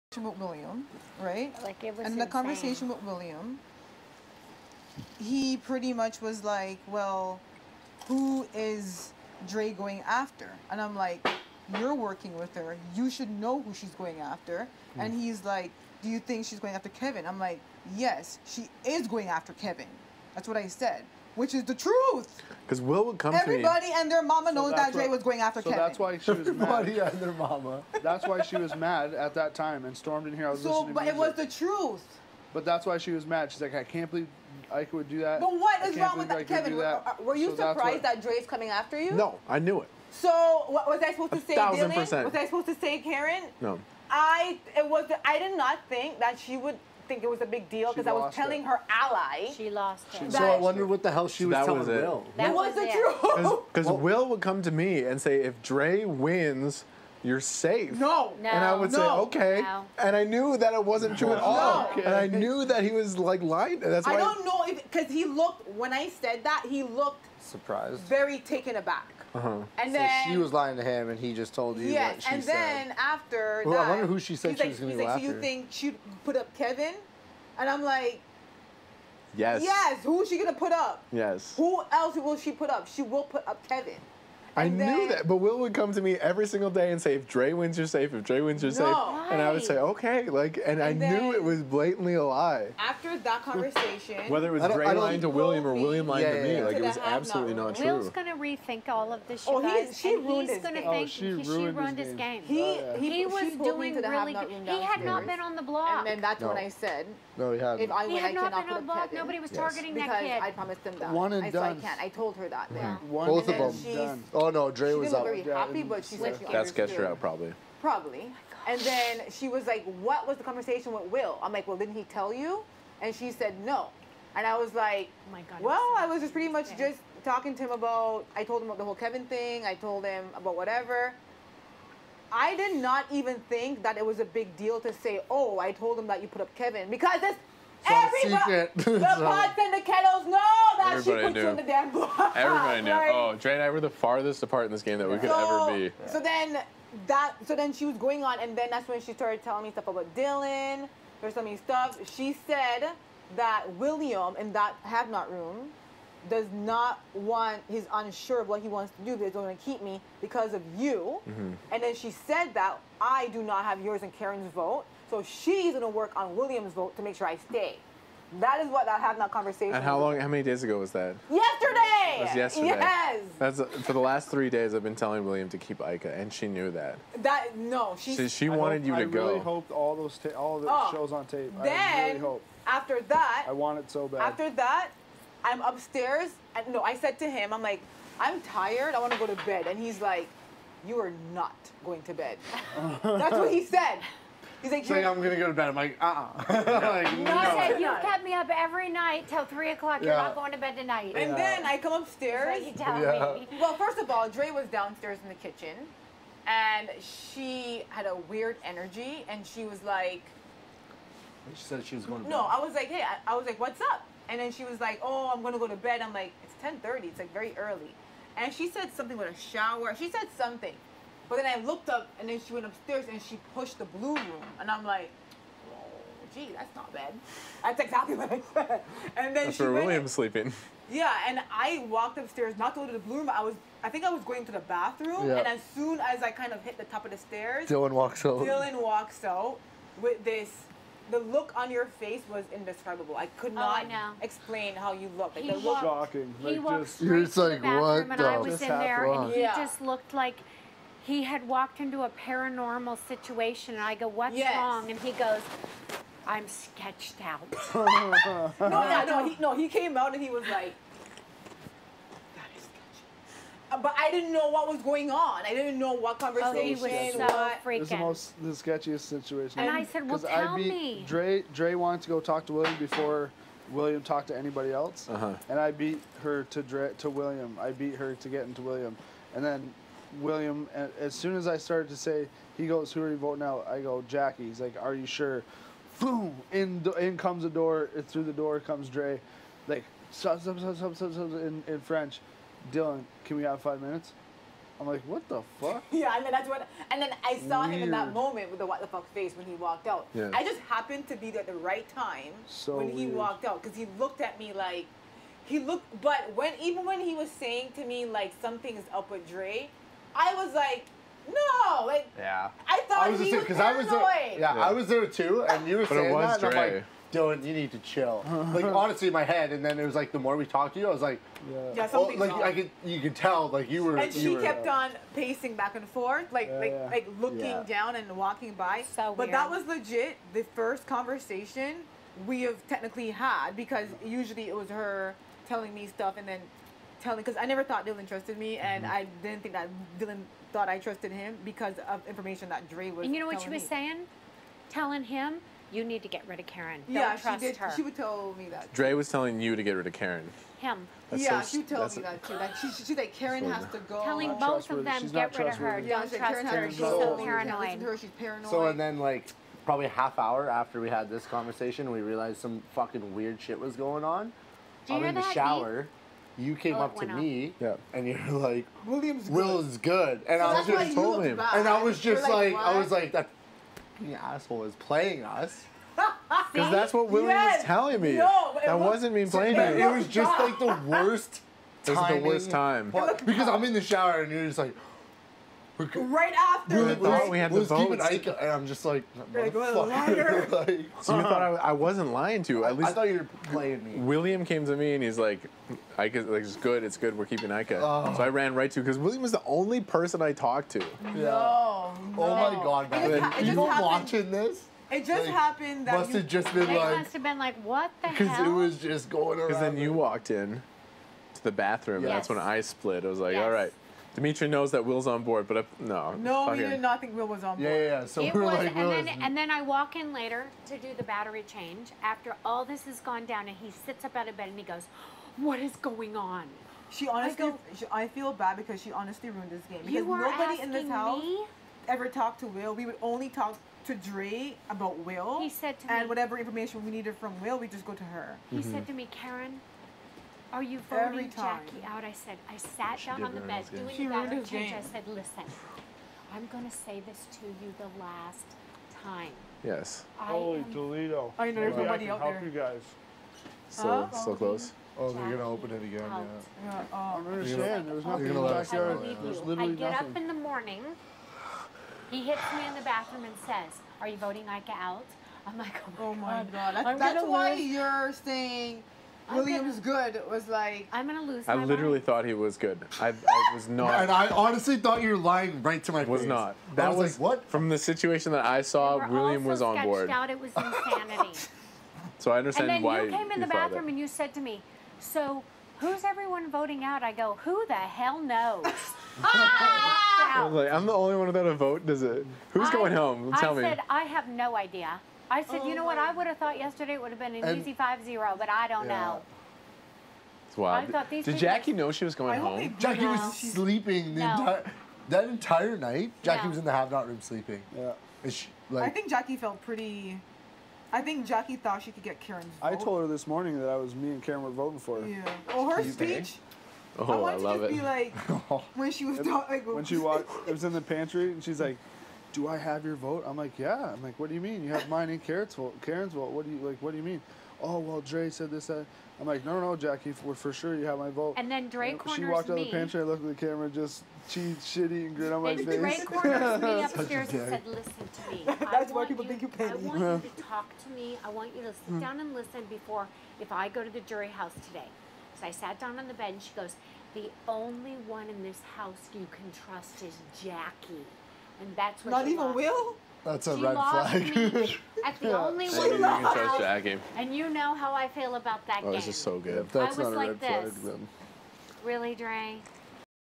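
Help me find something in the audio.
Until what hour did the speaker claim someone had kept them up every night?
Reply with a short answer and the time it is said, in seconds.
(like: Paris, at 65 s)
3 o'clock, at 199 s.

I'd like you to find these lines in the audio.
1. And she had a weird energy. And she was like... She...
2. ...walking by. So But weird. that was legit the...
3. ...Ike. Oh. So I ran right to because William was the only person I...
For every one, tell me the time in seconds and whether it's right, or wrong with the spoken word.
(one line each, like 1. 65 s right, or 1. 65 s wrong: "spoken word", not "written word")
1. 206 s right
2. 328 s right
3. 397 s right.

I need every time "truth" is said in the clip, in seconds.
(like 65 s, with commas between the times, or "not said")
21 s, 31 s, 52 s.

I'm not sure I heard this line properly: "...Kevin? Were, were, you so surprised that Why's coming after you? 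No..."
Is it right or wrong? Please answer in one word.
wrong.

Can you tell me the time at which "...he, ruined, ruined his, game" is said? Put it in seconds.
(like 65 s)
101 s.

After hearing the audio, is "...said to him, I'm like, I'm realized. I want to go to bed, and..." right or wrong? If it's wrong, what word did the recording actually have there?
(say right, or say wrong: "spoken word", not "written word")
wrong: "tired", not "realized".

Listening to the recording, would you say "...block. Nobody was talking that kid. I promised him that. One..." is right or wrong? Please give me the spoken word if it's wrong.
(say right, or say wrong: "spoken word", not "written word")
wrong: "targeting", not "talking".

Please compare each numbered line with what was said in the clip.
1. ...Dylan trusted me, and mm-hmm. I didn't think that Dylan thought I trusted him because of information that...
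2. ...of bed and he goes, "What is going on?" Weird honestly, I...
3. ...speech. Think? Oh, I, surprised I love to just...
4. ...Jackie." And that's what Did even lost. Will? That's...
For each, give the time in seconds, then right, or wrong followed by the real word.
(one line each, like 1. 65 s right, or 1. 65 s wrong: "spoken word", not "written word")
1. 337 s right
2. 424 s wrong: "She", not "Weird"
3. 515 s wrong: "wanted", not "surprised"
4. 550 s wrong: "Not", not "Did".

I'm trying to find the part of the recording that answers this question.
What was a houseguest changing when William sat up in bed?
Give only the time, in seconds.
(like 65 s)
421 s.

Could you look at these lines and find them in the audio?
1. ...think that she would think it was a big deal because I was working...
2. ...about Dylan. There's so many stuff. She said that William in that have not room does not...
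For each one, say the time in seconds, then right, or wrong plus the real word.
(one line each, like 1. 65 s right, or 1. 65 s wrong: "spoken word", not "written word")
1. 45 s wrong: "telling", not "working"
2. 149 s right.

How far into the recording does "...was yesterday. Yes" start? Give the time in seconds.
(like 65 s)
172 s.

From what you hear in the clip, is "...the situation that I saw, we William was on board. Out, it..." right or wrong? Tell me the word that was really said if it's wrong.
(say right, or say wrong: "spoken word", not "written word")
right.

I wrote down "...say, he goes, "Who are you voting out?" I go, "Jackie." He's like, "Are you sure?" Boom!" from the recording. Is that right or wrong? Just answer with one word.
right.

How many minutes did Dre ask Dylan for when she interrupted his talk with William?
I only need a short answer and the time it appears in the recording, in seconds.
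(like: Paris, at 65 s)
5, at 293 s.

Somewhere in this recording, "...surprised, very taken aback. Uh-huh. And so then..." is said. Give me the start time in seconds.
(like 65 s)
67 s.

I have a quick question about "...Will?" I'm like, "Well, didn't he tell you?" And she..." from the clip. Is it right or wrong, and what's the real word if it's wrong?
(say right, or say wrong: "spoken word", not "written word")
right.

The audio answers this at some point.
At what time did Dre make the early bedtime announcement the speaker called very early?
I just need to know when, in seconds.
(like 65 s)
216 s.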